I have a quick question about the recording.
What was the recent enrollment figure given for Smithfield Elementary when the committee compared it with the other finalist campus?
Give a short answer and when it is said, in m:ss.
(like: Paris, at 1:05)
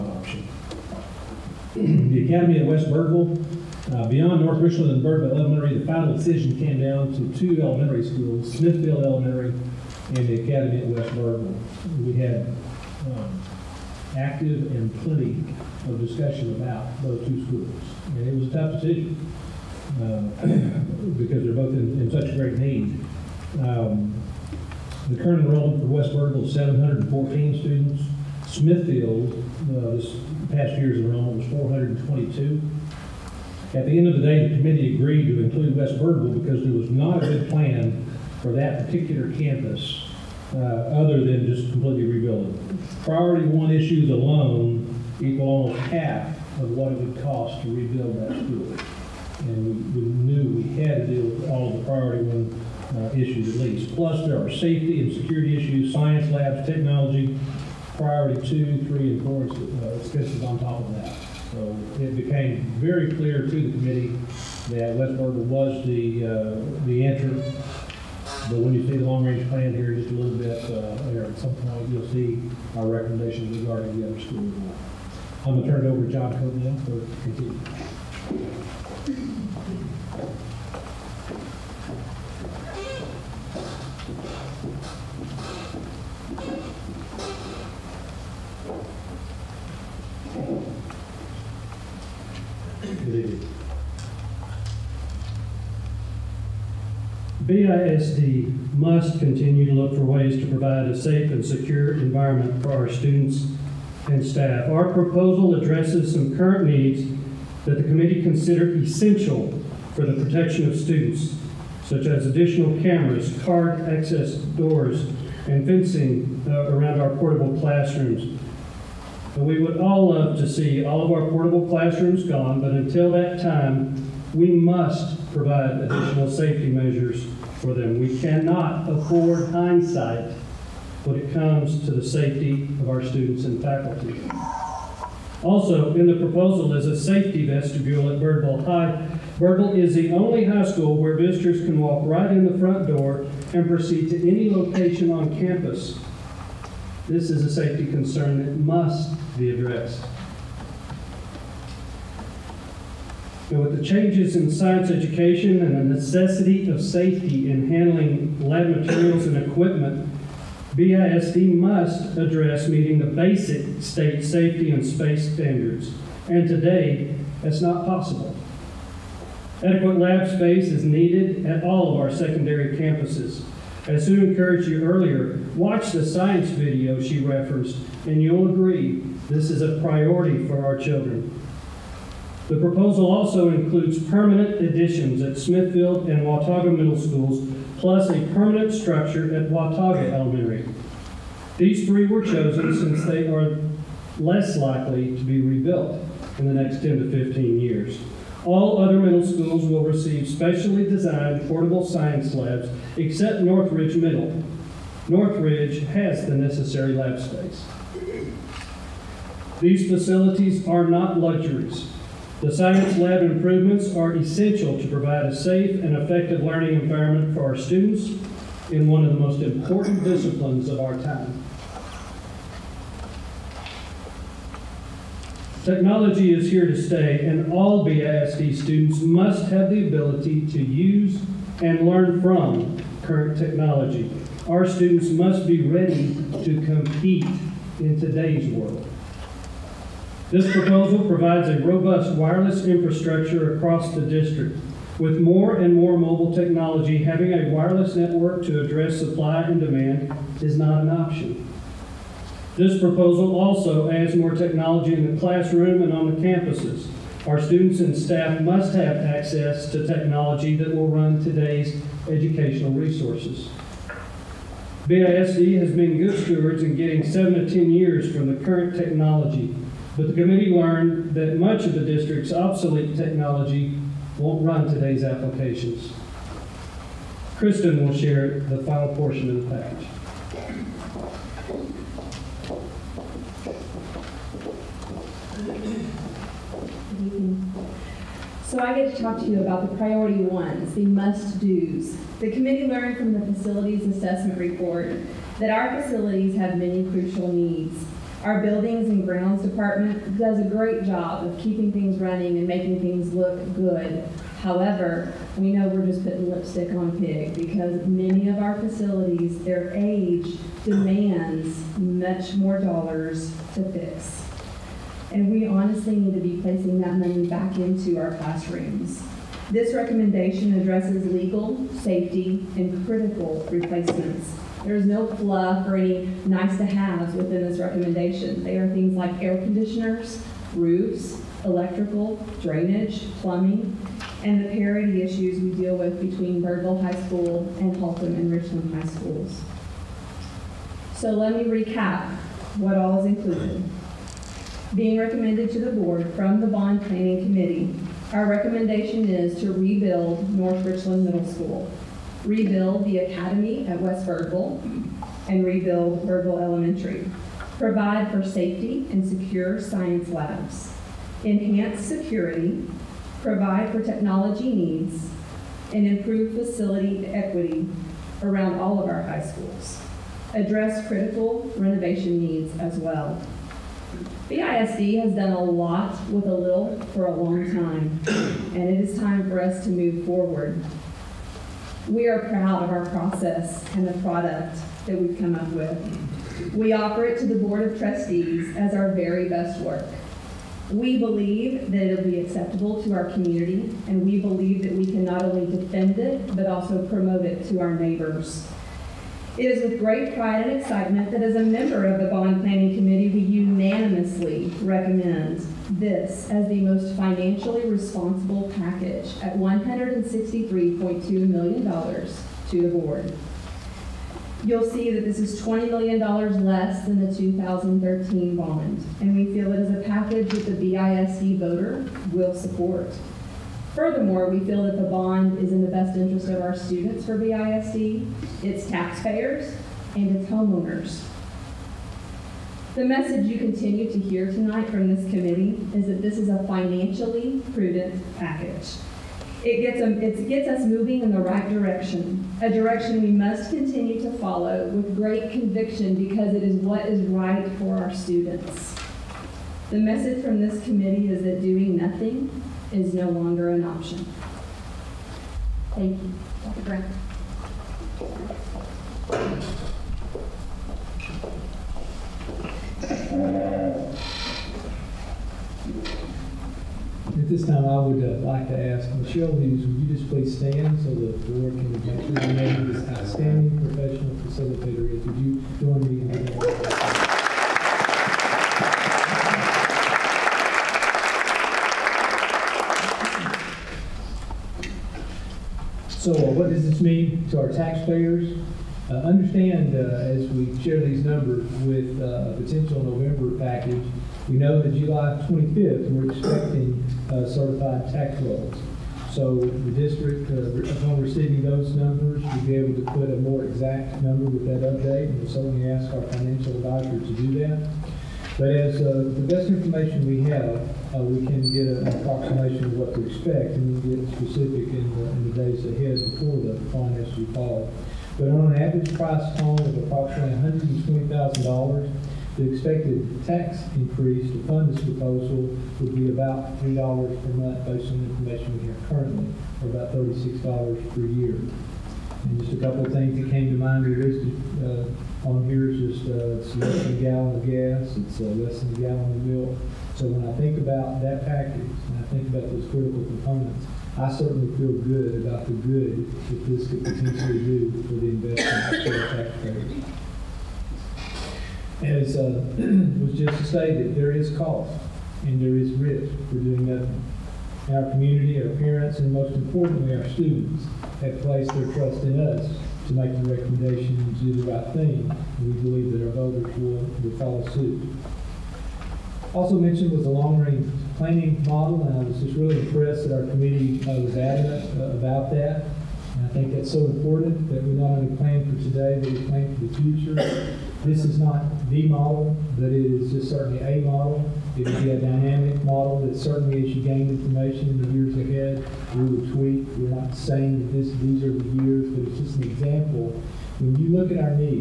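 422, at 0:31.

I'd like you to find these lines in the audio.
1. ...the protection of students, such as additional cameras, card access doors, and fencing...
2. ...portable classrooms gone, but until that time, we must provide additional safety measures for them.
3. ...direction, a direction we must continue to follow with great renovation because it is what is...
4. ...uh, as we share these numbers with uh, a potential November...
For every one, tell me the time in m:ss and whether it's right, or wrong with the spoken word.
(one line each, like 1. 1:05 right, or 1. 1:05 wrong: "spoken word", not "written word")
1. 1:50 right
2. 2:01 right
3. 7:21 wrong: "conviction", not "renovation"
4. 8:09 right.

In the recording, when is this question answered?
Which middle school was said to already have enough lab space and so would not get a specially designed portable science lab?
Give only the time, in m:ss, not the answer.
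3:23.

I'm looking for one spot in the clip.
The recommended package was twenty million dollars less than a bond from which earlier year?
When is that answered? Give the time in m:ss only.
6:57.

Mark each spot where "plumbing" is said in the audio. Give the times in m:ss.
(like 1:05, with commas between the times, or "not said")
5:33.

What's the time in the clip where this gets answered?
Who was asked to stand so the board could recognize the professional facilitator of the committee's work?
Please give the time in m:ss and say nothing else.
7:48.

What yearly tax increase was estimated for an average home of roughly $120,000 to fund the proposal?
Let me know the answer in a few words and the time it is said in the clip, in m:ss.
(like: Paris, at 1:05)
$36, at 8:49.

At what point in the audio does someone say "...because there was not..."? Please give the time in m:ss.
0:36.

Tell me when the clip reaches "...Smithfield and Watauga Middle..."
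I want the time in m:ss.
3:05.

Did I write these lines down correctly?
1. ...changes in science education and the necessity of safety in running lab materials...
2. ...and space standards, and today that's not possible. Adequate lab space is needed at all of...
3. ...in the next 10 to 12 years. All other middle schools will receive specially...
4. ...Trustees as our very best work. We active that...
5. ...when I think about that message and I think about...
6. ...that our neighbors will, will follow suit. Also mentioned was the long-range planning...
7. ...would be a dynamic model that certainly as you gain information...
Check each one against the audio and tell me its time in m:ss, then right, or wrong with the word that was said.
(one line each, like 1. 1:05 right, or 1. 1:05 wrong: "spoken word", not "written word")
1. 2:33 wrong: "handling", not "running"
2. 2:44 right
3. 3:16 wrong: "15", not "12"
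4. 6:27 wrong: "believe", not "active"
5. 9:00 wrong: "package", not "message"
6. 9:25 wrong: "voters", not "neighbors"
7. 9:44 right.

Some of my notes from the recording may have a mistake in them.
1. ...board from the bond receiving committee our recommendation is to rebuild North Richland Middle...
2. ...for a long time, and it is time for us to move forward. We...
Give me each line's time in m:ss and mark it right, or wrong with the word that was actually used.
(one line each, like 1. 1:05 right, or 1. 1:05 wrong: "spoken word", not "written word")
1. 5:45 wrong: "planning", not "receiving"
2. 6:16 right.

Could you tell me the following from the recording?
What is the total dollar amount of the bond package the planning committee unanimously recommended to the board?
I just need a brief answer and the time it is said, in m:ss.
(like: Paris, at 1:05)
$163.2 million, at 6:49.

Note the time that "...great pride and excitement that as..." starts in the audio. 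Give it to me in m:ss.
6:39.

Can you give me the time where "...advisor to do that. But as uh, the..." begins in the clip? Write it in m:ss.
8:26.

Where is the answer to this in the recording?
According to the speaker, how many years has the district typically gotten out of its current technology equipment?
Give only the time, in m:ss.
4:27.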